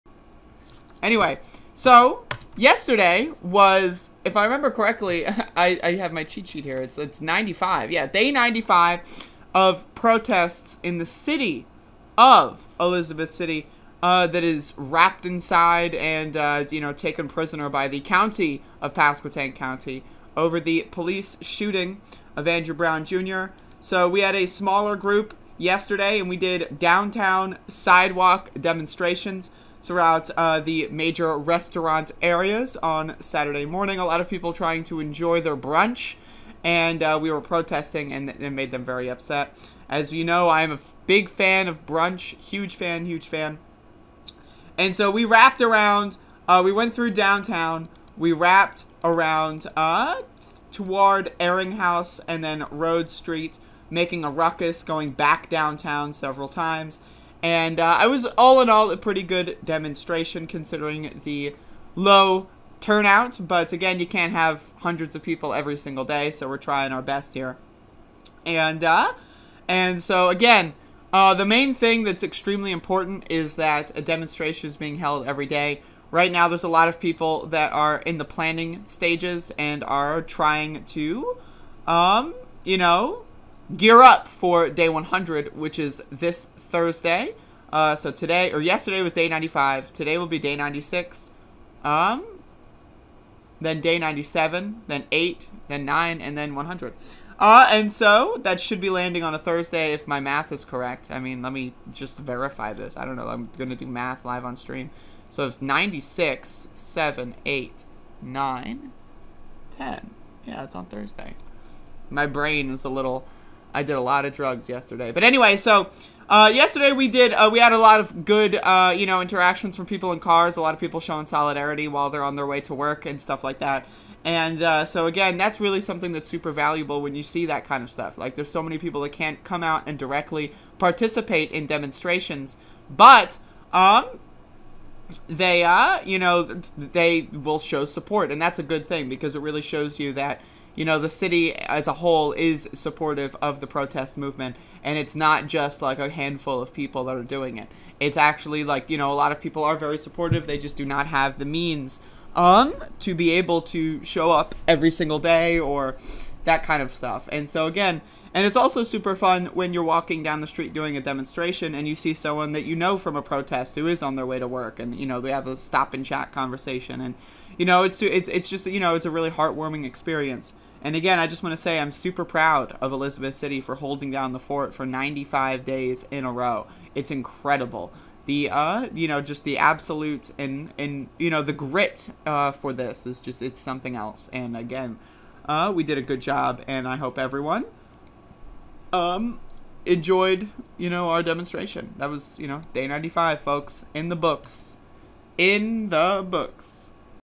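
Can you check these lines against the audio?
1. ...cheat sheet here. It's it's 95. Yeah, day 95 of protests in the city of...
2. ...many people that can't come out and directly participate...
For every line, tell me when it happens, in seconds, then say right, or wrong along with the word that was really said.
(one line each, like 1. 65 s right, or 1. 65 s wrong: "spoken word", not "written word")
1. 6 s right
2. 128 s right.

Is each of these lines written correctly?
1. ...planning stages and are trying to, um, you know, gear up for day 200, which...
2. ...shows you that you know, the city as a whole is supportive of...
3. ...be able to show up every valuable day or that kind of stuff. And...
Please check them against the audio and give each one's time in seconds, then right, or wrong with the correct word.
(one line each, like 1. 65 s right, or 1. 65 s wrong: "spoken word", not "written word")
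1. 78 s wrong: "100", not "200"
2. 139 s right
3. 153 s wrong: "single", not "valuable".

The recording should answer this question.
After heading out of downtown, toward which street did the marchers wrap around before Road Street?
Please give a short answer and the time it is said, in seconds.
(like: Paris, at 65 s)
Ehringhaus, at 51 s.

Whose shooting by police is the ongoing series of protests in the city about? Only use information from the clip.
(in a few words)
Andrew Brown Jr.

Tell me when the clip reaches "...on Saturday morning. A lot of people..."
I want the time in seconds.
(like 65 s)
32 s.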